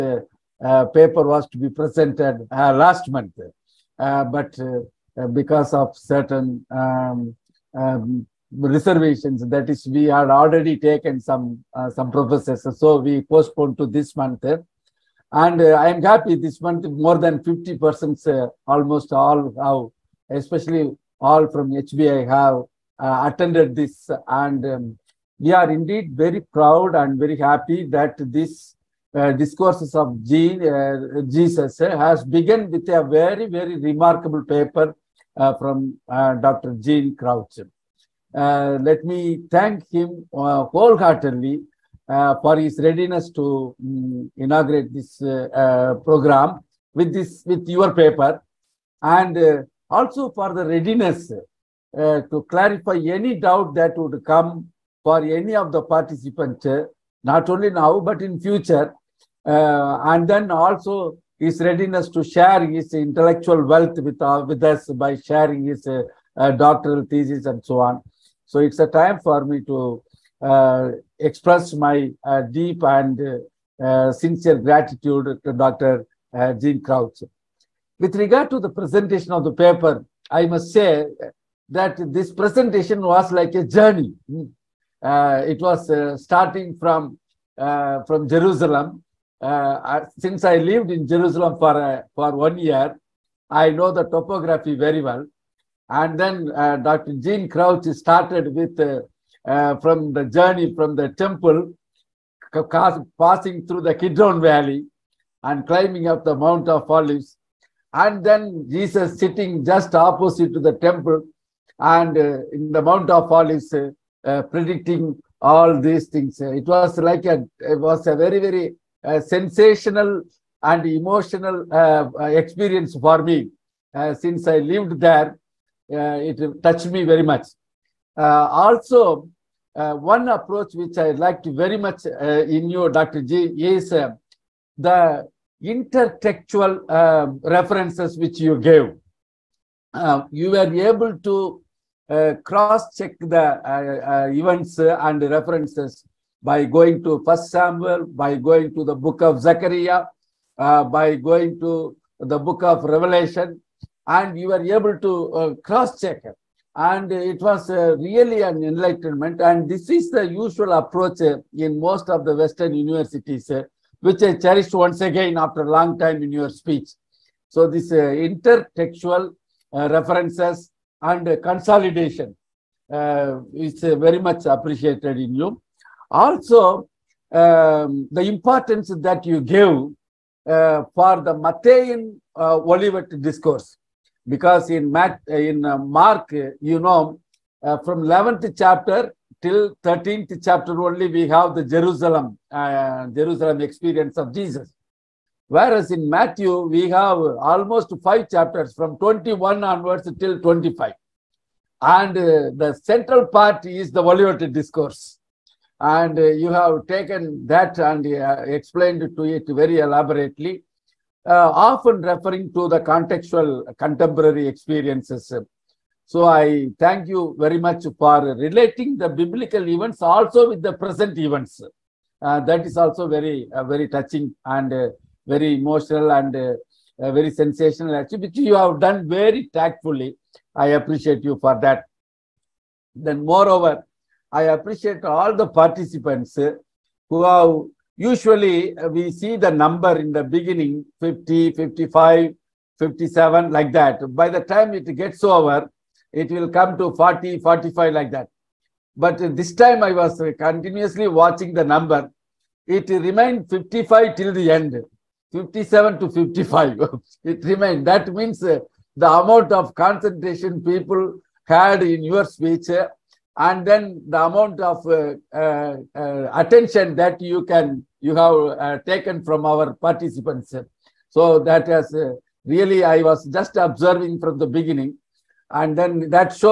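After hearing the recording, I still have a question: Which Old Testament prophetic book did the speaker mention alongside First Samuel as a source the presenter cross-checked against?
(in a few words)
Zechariah.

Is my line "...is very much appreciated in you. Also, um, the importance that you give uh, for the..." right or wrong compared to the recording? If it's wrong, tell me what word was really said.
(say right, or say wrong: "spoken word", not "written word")
right.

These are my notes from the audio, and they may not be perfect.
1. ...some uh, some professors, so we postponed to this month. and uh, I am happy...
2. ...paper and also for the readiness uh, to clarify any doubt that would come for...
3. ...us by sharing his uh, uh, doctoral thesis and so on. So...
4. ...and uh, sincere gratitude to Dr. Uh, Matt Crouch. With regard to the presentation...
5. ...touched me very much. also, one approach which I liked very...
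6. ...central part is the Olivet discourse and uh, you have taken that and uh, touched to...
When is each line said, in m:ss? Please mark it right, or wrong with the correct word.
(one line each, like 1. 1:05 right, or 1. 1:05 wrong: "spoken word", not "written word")
1. 0:11 right
2. 0:47 right
3. 1:04 right
4. 1:12 wrong: "Gene", not "Matt"
5. 2:06 right
6. 3:22 wrong: "explained", not "touched".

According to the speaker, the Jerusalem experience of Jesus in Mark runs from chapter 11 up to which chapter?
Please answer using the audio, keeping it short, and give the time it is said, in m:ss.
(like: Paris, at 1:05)
13, at 3:09.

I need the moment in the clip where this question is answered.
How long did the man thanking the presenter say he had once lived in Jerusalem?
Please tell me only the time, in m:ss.
1:32.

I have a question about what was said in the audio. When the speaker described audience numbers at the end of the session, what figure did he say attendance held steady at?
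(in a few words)
55.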